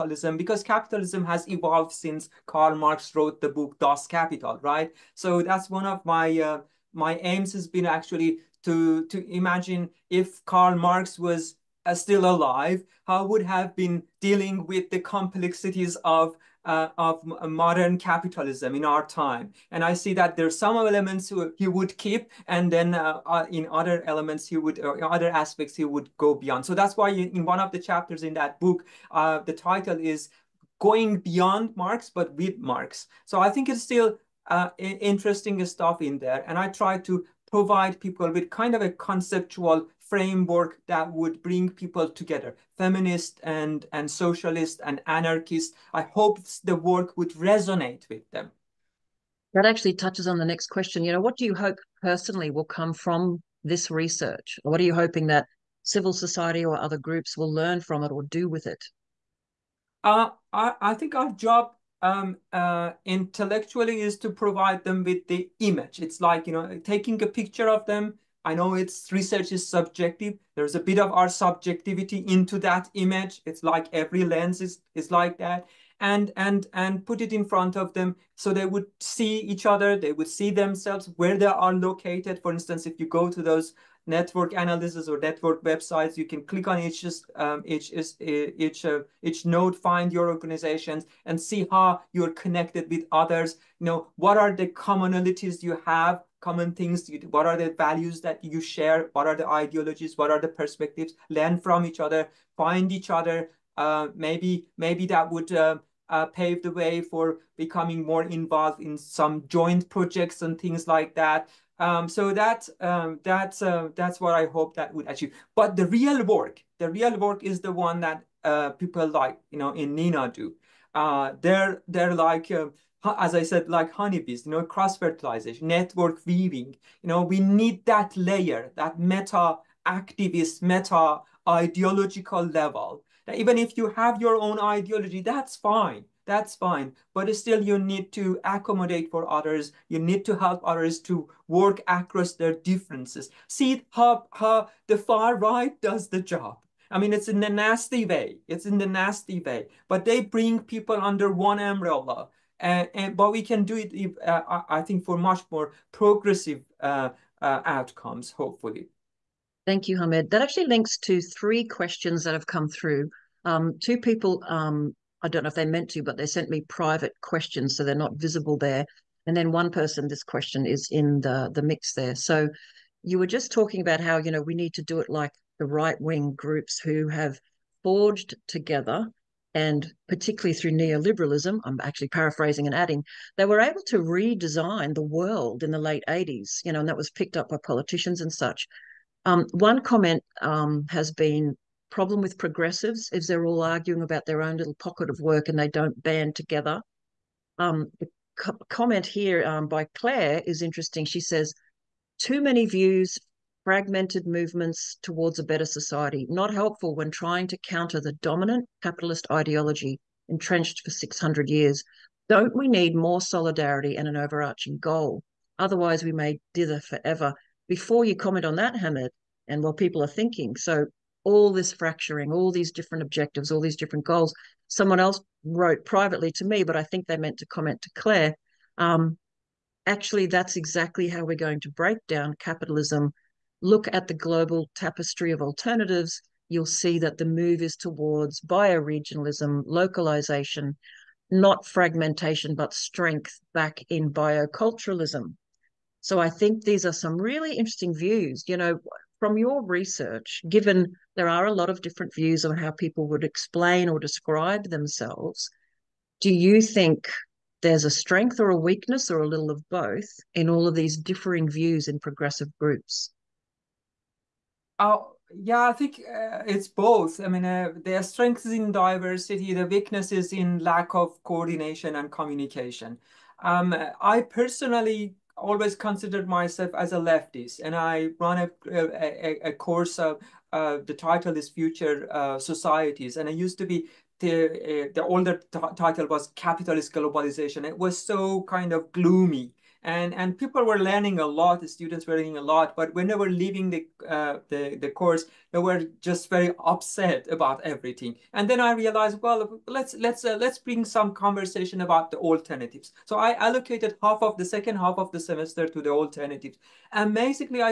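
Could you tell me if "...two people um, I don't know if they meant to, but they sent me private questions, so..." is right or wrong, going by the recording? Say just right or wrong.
right.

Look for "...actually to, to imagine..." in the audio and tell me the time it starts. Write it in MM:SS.
00:07.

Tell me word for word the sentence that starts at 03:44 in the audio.
Someone else wrote privately to me, but I think they meant to comment to Claire.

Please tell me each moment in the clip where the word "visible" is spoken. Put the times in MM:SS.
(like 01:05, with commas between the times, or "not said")
02:48.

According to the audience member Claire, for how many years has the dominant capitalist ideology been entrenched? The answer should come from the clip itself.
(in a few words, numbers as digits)
600.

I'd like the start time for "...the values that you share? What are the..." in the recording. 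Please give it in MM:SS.
01:37.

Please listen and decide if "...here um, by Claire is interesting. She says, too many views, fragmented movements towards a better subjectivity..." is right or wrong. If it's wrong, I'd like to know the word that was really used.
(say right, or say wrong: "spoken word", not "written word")
wrong: "society", not "subjectivity".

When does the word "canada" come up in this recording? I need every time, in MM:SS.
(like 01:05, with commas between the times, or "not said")
not said.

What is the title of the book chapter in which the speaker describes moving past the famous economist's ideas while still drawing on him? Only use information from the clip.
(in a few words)
Going Beyond Marx, but with Marx.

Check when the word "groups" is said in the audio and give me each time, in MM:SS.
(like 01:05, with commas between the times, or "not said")
00:56, 02:56, 04:22.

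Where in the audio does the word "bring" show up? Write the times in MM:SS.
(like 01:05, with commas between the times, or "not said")
00:41, 02:30, 05:00.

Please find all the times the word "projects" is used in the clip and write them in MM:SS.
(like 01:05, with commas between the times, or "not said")
01:49.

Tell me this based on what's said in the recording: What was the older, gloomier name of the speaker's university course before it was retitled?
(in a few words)
Capitalist Globalization.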